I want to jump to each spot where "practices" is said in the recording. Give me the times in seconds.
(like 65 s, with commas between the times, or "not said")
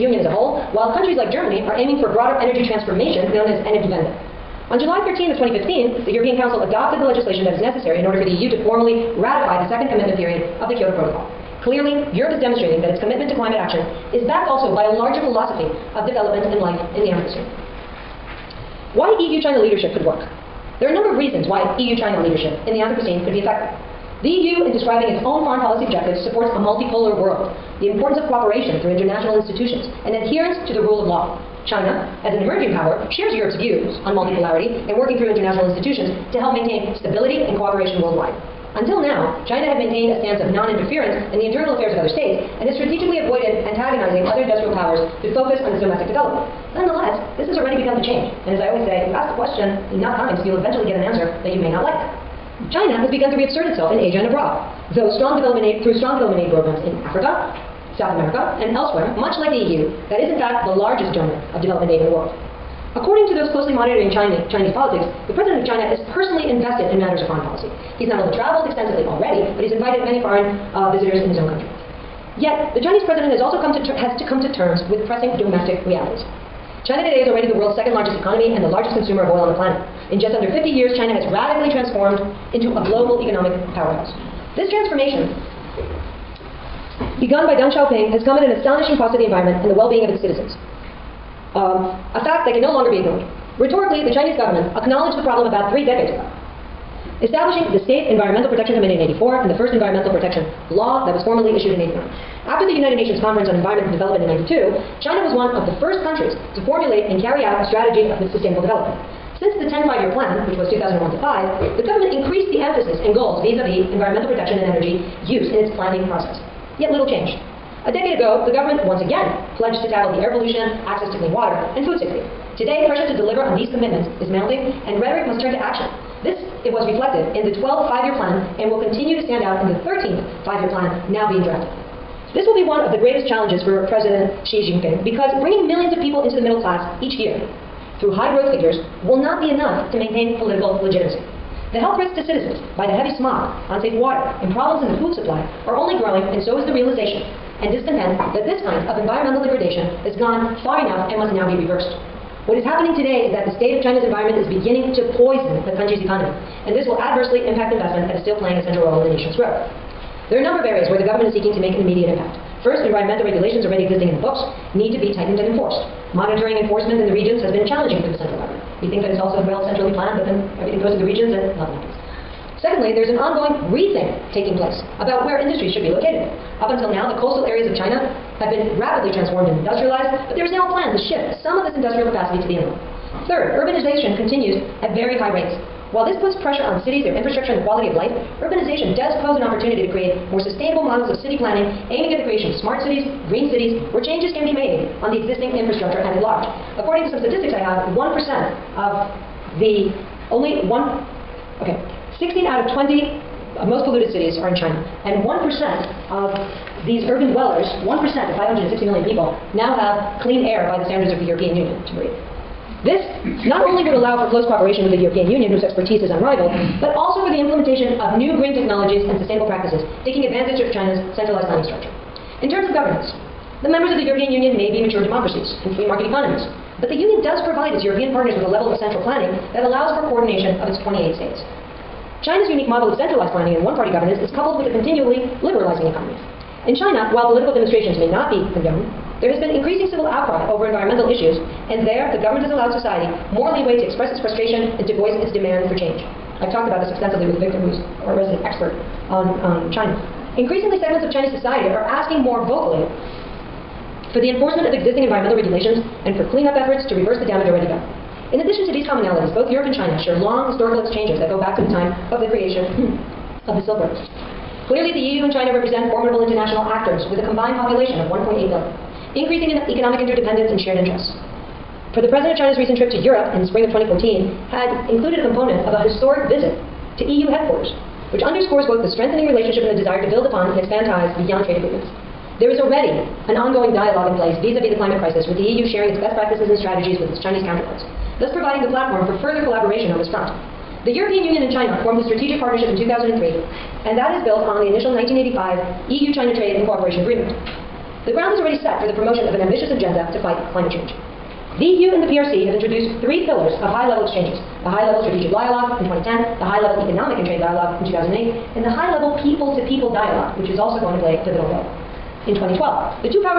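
219 s, 286 s.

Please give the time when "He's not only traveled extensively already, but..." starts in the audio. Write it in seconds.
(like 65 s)
67 s.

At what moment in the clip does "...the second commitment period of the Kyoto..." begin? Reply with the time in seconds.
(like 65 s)
9 s.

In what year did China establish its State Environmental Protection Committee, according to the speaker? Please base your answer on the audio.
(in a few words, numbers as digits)
1984.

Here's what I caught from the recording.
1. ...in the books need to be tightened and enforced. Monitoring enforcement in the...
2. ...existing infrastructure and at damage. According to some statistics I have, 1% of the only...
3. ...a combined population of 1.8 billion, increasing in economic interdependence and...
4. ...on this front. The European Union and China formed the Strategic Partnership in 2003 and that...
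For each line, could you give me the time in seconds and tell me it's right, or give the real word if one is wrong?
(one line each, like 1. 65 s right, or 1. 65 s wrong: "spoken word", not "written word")
1. 164 s right
2. 195 s wrong: "large", not "damage"
3. 267 s right
4. 289 s right.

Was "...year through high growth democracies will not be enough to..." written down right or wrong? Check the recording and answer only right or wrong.
wrong.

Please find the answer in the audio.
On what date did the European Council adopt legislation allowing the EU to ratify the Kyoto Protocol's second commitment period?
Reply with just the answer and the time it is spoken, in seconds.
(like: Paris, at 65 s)
July 13, 2015, at 4 s.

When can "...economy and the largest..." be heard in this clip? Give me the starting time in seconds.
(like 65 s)
78 s.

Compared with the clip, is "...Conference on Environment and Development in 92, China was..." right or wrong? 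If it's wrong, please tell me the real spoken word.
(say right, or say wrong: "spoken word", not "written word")
right.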